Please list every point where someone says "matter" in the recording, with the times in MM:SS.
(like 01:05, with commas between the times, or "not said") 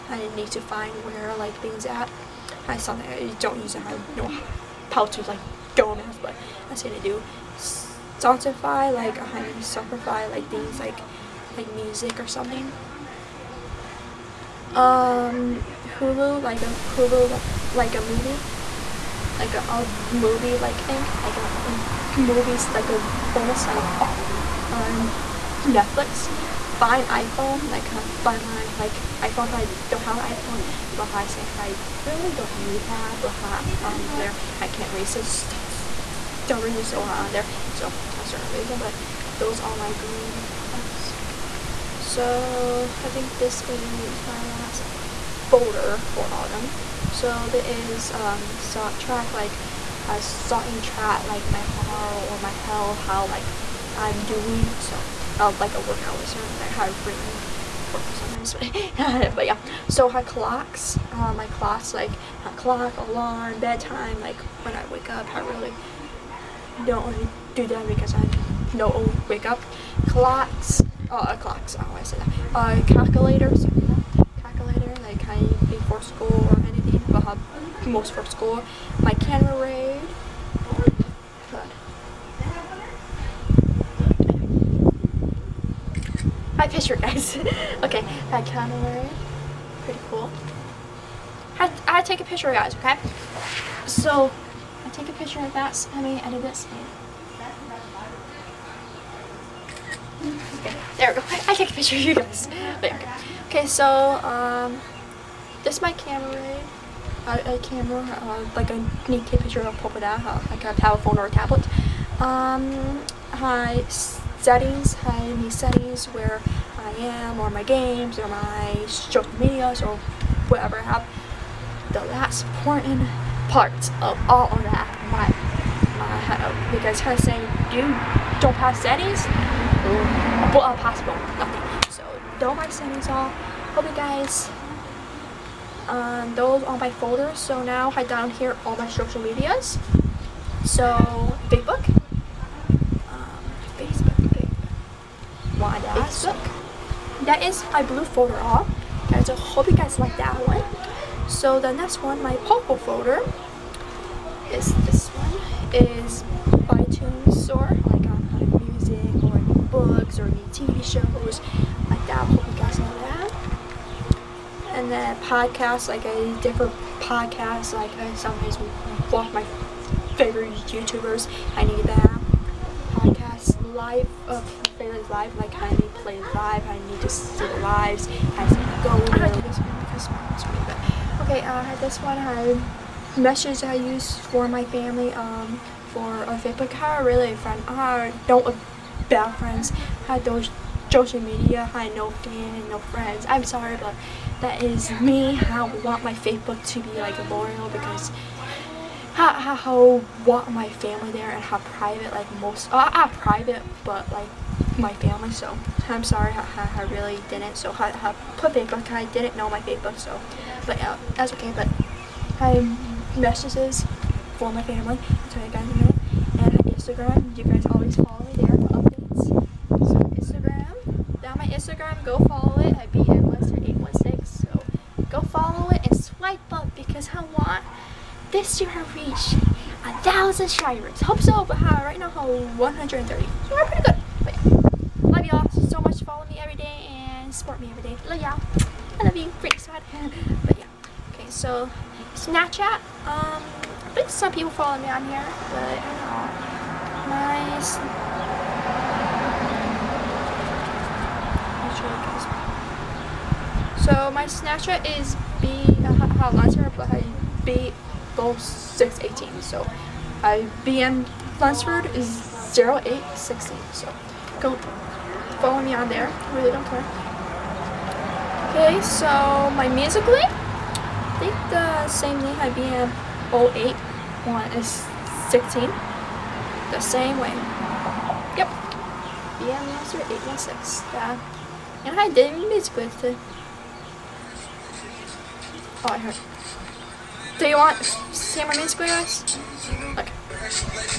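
not said.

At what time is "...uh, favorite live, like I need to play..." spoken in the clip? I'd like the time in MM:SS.
02:54.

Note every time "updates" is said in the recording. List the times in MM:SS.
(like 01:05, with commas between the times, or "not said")
03:38.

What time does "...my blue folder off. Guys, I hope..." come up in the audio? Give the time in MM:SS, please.
02:27.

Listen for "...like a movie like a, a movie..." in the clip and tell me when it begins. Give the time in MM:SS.
00:17.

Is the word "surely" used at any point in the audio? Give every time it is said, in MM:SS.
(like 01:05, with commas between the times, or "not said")
not said.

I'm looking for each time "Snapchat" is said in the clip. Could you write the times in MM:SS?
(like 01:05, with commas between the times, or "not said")
04:02, 04:14.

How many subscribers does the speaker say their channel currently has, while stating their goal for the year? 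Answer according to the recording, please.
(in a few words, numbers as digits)
130.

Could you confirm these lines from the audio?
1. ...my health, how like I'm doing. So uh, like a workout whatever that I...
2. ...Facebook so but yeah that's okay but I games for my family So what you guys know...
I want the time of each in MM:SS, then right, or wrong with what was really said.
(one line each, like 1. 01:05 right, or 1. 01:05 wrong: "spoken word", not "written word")
1. 00:52 wrong: "listener", not "whatever"
2. 03:29 wrong: "messages", not "games".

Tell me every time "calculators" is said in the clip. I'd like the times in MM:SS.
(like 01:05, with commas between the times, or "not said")
01:12.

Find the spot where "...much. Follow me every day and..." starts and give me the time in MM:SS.
03:55.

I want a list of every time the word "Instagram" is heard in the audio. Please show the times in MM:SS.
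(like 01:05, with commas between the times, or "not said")
03:36, 03:41.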